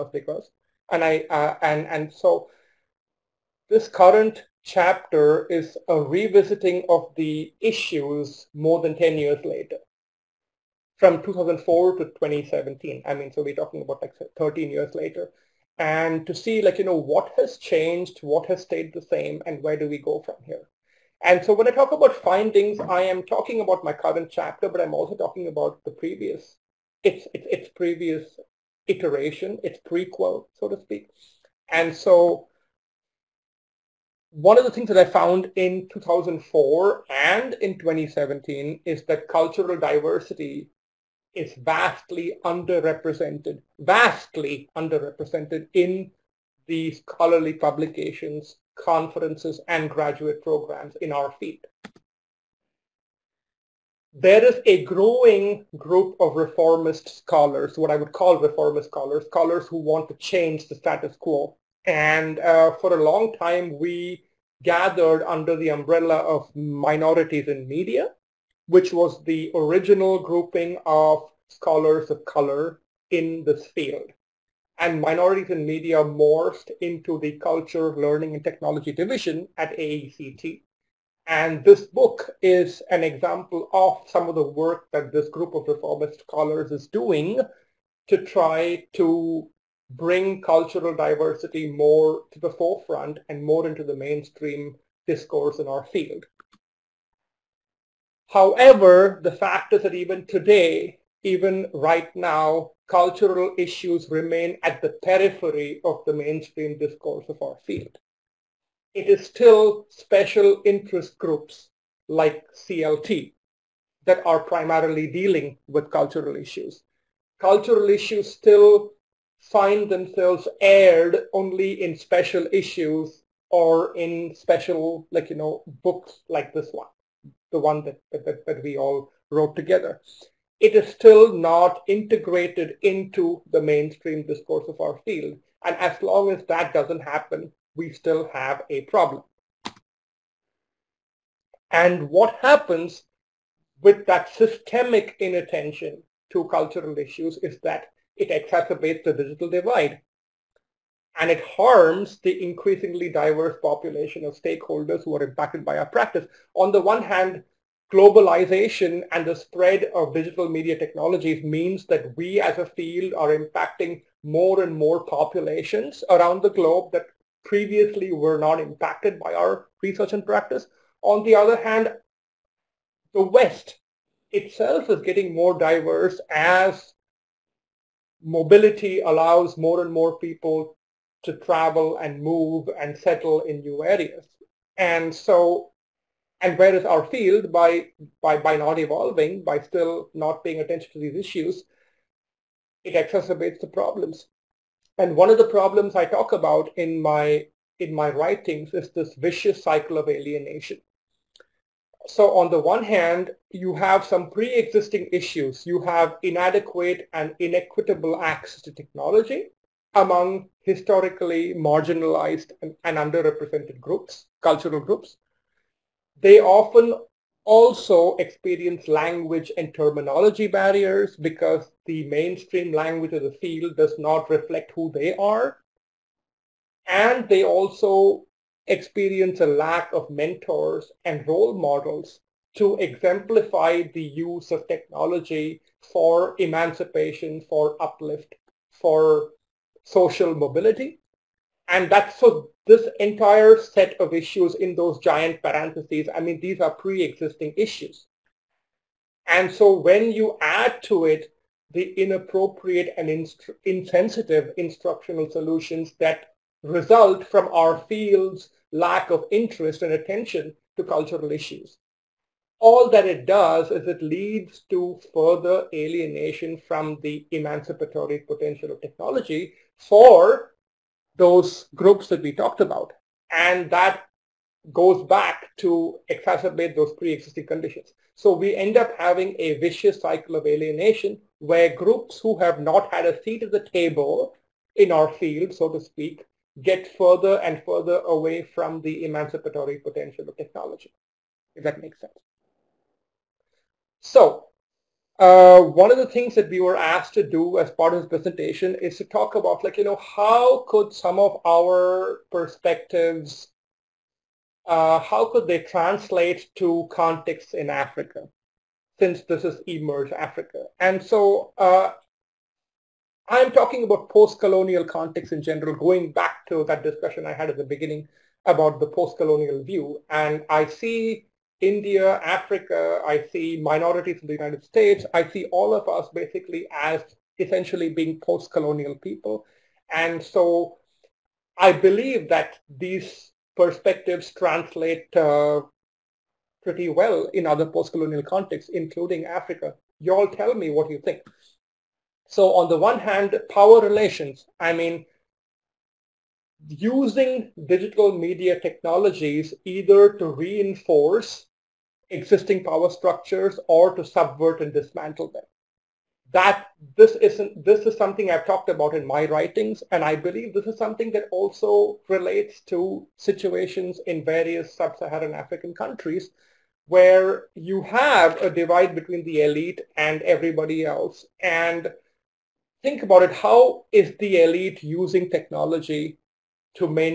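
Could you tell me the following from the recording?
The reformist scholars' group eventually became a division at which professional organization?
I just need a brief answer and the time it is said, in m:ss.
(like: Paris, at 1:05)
AECT, at 1:19.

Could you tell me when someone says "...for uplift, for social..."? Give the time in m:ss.
3:57.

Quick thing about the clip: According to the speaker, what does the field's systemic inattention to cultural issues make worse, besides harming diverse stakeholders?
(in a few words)
The digital divide.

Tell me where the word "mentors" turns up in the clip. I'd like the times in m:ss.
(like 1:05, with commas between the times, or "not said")
3:50.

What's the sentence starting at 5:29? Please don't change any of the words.
And so I believe that these perspectives translate uh, pretty well in other post-colonial contexts, including Africa.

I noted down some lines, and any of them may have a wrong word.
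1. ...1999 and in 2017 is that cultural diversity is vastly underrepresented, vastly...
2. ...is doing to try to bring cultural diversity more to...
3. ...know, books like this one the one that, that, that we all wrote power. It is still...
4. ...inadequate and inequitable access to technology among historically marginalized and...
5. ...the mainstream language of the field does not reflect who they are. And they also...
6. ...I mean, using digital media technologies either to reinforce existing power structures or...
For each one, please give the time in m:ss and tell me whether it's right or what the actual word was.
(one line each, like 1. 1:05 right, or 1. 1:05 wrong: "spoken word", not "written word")
1. 0:35 wrong: "2004", not "1999"
2. 1:26 right
3. 2:05 wrong: "together", not "power"
4. 3:26 right
5. 3:41 right
6. 5:44 right.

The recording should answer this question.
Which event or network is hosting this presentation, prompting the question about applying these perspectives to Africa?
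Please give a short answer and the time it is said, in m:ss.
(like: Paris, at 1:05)
e/merge Africa, at 5:09.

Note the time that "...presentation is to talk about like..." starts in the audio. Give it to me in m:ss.
4:58.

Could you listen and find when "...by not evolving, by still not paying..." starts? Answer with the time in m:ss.
3:08.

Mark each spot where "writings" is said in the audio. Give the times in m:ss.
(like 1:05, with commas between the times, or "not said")
3:18, 5:59.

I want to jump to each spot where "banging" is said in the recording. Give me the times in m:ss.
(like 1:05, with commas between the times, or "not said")
not said.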